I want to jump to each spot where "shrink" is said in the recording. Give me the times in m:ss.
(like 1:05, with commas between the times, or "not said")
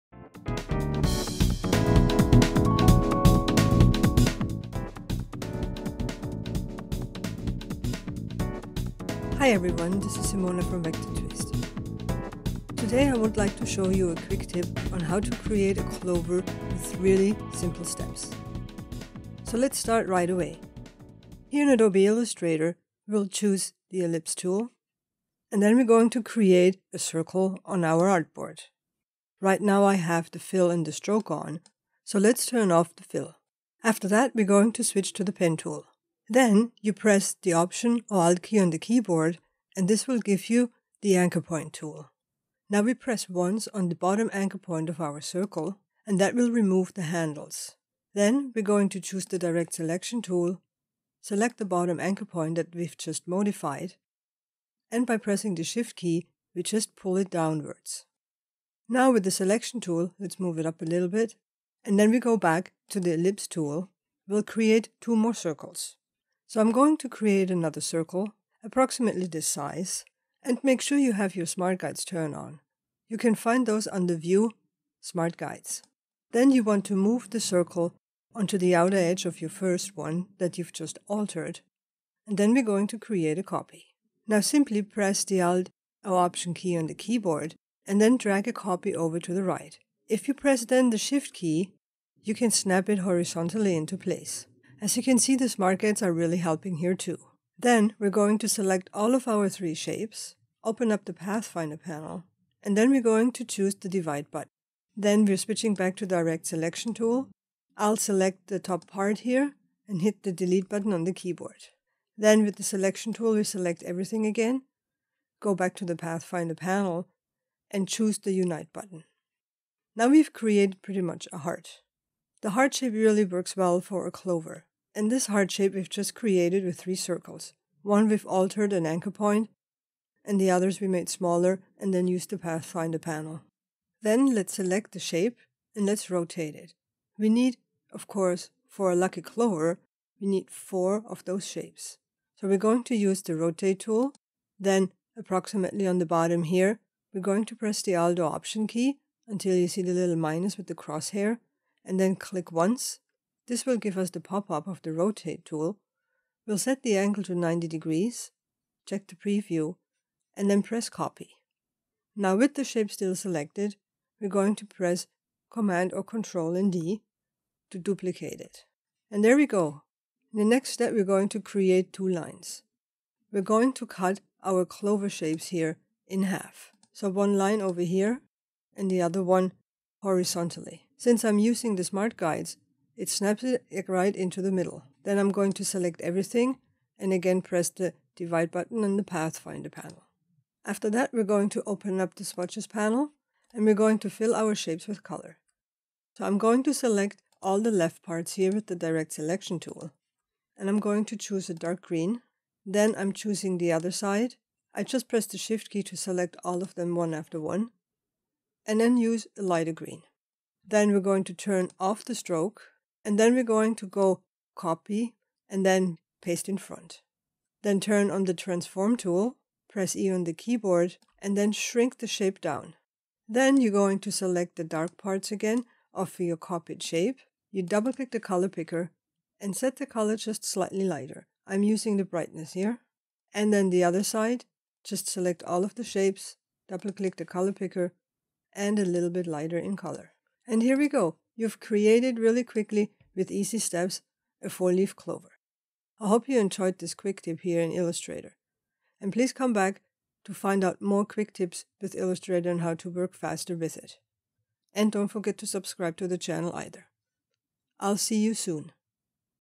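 3:41.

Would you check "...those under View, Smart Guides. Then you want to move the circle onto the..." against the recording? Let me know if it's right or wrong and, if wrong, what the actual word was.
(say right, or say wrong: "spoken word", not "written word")
right.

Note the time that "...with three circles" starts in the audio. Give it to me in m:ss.
2:06.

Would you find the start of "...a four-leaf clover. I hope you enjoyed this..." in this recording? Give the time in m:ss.
4:04.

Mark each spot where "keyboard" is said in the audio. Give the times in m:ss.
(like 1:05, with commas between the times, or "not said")
0:38, 1:26, 1:51, 3:40.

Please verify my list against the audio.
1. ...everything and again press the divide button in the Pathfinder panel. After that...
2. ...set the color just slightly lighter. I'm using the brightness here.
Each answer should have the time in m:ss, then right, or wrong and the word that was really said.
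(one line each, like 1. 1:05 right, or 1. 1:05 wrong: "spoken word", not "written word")
1. 3:06 right
2. 3:49 right.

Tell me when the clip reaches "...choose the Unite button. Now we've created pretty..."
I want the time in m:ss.
1:57.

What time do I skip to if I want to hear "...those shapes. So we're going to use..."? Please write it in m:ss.
2:21.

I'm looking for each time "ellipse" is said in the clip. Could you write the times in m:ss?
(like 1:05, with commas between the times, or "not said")
0:24, 1:03.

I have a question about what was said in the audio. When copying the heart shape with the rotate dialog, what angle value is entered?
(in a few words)
90 degrees.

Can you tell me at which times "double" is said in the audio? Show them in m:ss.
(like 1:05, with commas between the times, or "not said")
3:47, 3:56.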